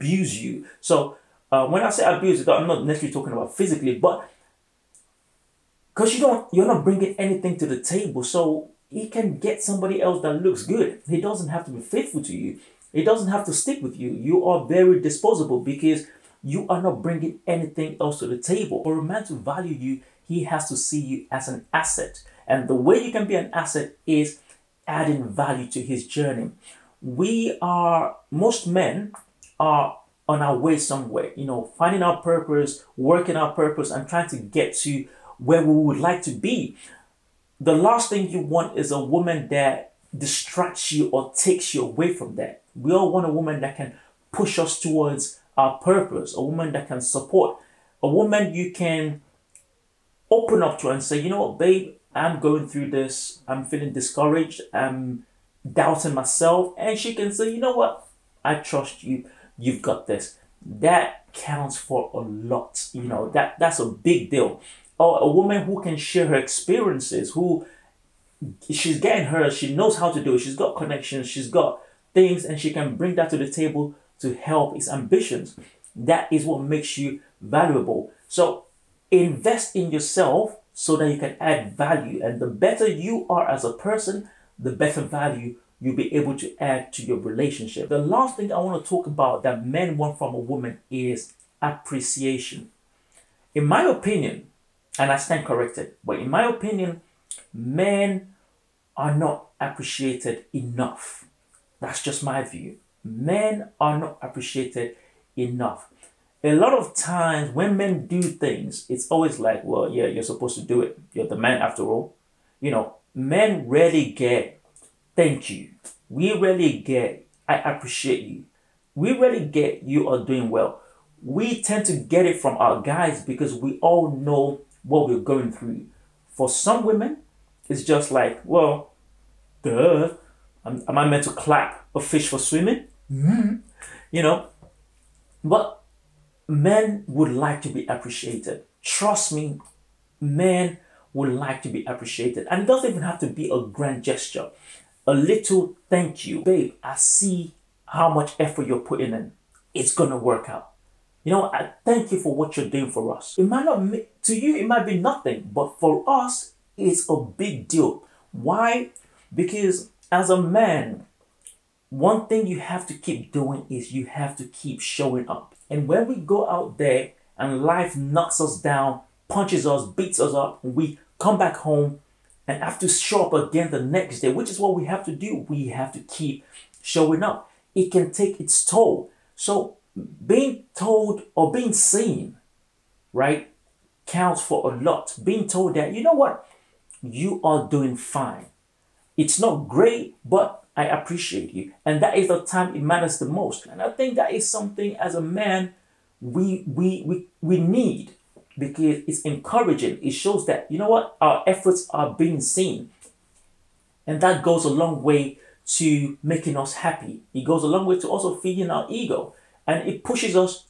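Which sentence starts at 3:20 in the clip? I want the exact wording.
It shows that you know what our efforts are being seen.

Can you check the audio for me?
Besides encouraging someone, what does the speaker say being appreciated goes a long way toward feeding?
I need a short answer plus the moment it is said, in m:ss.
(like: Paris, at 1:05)
ego, at 3:28.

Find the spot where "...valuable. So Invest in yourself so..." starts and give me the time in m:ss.
1:17.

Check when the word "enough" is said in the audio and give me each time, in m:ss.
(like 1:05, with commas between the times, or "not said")
1:40, 1:45.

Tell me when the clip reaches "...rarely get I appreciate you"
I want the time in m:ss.
1:56.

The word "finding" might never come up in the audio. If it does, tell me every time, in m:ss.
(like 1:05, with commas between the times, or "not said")
0:31.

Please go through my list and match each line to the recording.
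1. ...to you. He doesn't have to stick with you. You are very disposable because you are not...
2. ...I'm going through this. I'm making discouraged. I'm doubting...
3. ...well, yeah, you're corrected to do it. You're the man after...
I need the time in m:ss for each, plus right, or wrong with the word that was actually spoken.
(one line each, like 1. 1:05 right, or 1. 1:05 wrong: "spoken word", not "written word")
1. 0:12 right
2. 0:52 wrong: "feeling", not "making"
3. 1:49 wrong: "supposed", not "corrected".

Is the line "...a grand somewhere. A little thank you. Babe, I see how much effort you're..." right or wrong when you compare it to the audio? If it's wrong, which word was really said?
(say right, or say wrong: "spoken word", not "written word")
wrong: "gesture", not "somewhere".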